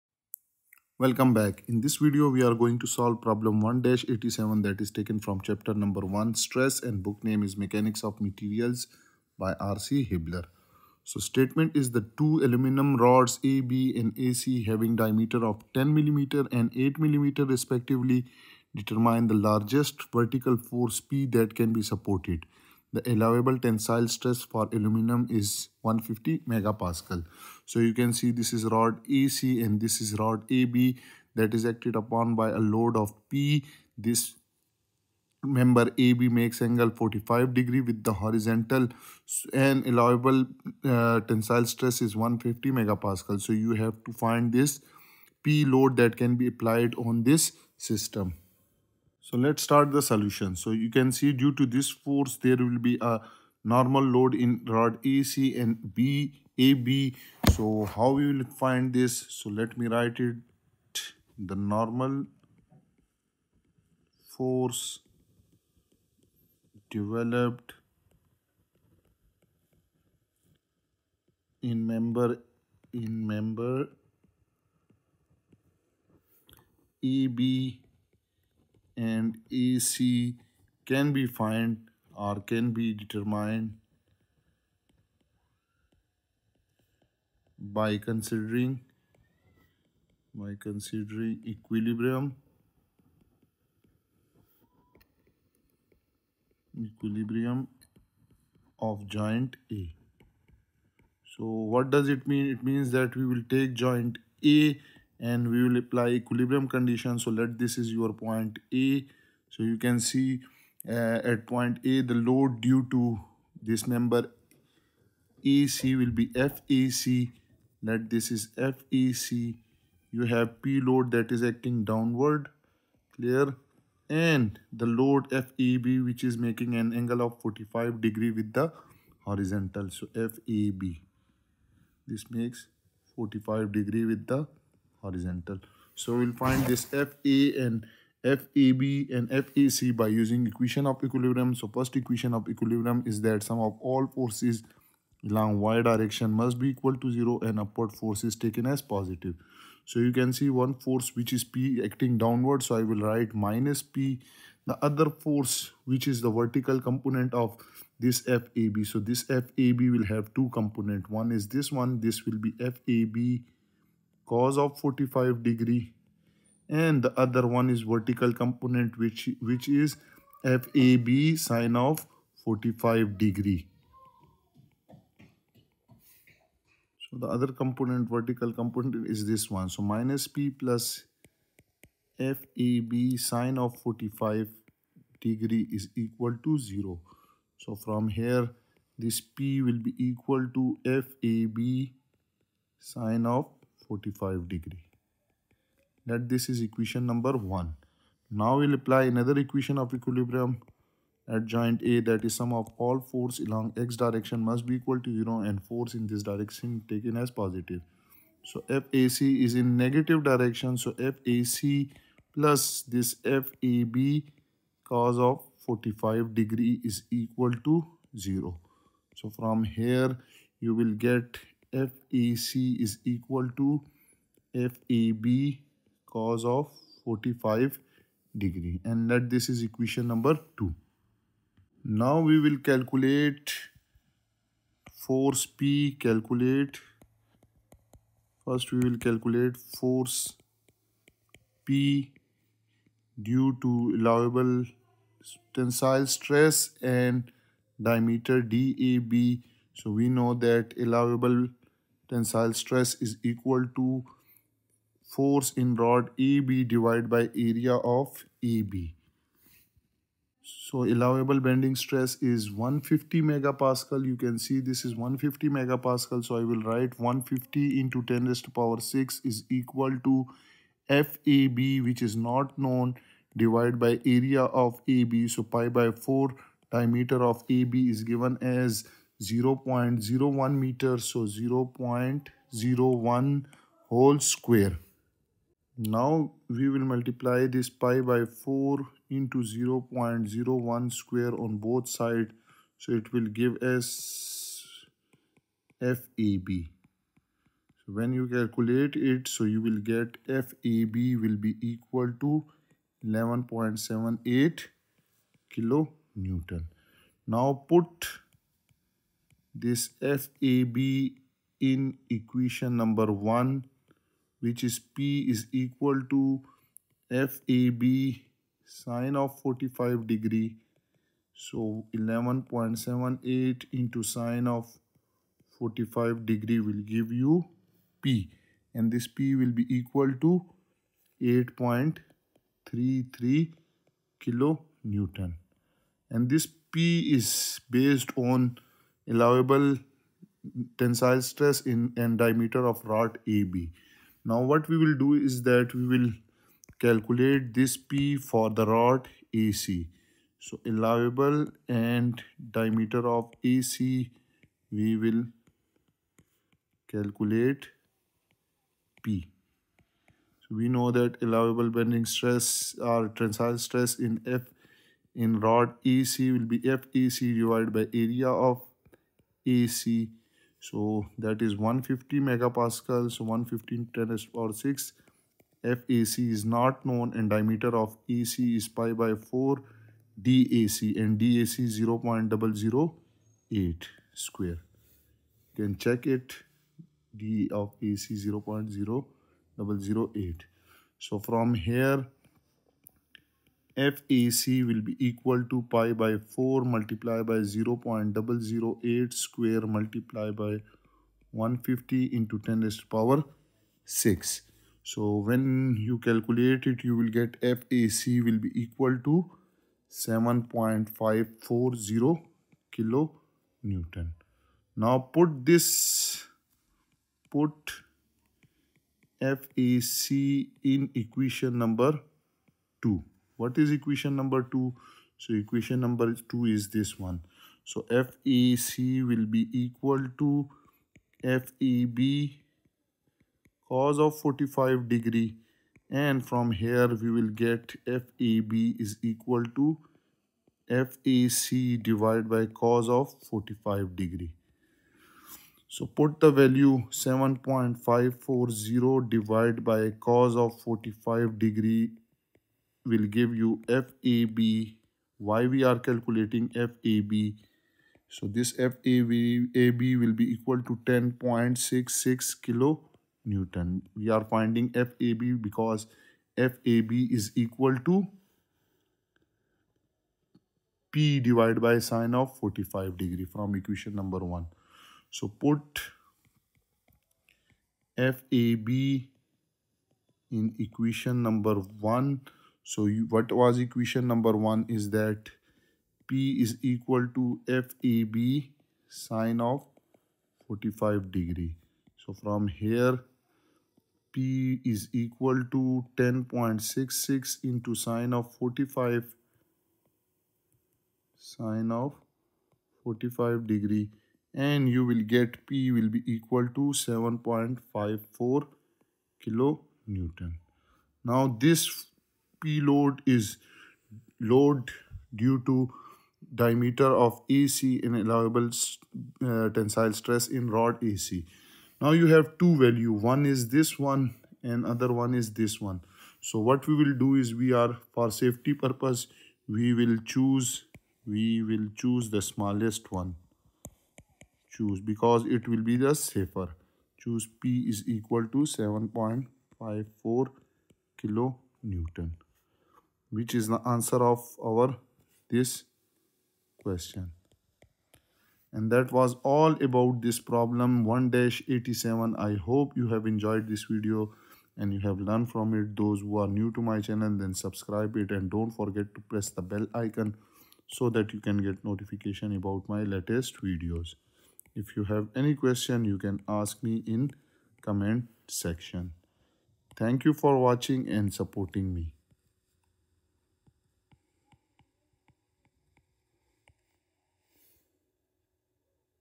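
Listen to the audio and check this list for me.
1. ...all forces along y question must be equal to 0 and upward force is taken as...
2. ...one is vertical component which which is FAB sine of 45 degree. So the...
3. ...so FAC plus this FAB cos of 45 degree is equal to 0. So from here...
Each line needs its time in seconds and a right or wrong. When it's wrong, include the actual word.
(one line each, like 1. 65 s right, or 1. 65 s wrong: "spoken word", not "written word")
1. 143 s wrong: "direction", not "question"
2. 167 s right
3. 210 s right.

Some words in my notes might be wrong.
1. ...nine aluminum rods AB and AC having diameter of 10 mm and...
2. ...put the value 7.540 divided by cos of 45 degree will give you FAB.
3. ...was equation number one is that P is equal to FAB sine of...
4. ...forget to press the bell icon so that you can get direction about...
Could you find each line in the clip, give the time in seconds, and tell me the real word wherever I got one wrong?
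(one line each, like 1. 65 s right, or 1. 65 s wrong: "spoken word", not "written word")
1. 12 s wrong: "two", not "nine"
2. 445 s right
3. 483 s right
4. 558 s wrong: "notification", not "direction".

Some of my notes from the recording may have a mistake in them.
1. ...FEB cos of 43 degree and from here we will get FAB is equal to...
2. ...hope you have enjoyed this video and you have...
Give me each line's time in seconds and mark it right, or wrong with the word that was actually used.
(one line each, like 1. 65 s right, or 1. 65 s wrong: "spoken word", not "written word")
1. 431 s wrong: "45", not "43"
2. 552 s right.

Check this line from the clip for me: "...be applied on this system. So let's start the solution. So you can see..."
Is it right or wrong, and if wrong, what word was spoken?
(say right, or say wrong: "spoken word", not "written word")
right.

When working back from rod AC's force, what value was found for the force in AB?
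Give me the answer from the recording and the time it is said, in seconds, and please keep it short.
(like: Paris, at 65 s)
10.66 kN, at 460 s.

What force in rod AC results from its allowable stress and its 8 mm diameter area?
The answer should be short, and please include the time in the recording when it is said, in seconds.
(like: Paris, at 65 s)
7.540 kN, at 409 s.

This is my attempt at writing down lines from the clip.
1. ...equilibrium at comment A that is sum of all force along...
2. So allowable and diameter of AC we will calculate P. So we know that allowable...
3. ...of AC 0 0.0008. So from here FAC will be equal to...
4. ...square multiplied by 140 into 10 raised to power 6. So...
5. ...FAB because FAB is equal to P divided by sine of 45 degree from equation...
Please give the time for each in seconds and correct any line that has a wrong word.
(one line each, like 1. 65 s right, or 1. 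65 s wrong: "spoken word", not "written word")
1. 199 s wrong: "joint", not "comment"
2. 350 s right
3. 387 s right
4. 399 s wrong: "150", not "140"
5. 464 s right.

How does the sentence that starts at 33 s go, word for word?
This member AB makes angle 45 degree with the horizontal and allowable uh, tensile stress is 150 megapascal.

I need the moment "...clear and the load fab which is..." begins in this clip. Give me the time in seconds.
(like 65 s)
123 s.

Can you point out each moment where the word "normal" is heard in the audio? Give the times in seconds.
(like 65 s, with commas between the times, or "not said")
53 s, 61 s.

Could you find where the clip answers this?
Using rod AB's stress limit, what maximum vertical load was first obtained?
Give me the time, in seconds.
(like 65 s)
331 s.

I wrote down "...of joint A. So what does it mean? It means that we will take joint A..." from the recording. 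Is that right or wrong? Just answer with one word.
right.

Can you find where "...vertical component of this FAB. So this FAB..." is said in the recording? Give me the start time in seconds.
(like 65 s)
156 s.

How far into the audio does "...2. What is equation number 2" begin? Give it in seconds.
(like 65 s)
422 s.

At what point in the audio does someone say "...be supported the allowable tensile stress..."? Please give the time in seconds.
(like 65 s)
21 s.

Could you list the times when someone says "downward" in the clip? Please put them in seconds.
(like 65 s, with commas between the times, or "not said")
121 s, 152 s.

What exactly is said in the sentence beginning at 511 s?
Now this P load is load due to diameter of AC and allowable uh, tensile stress in rod AC.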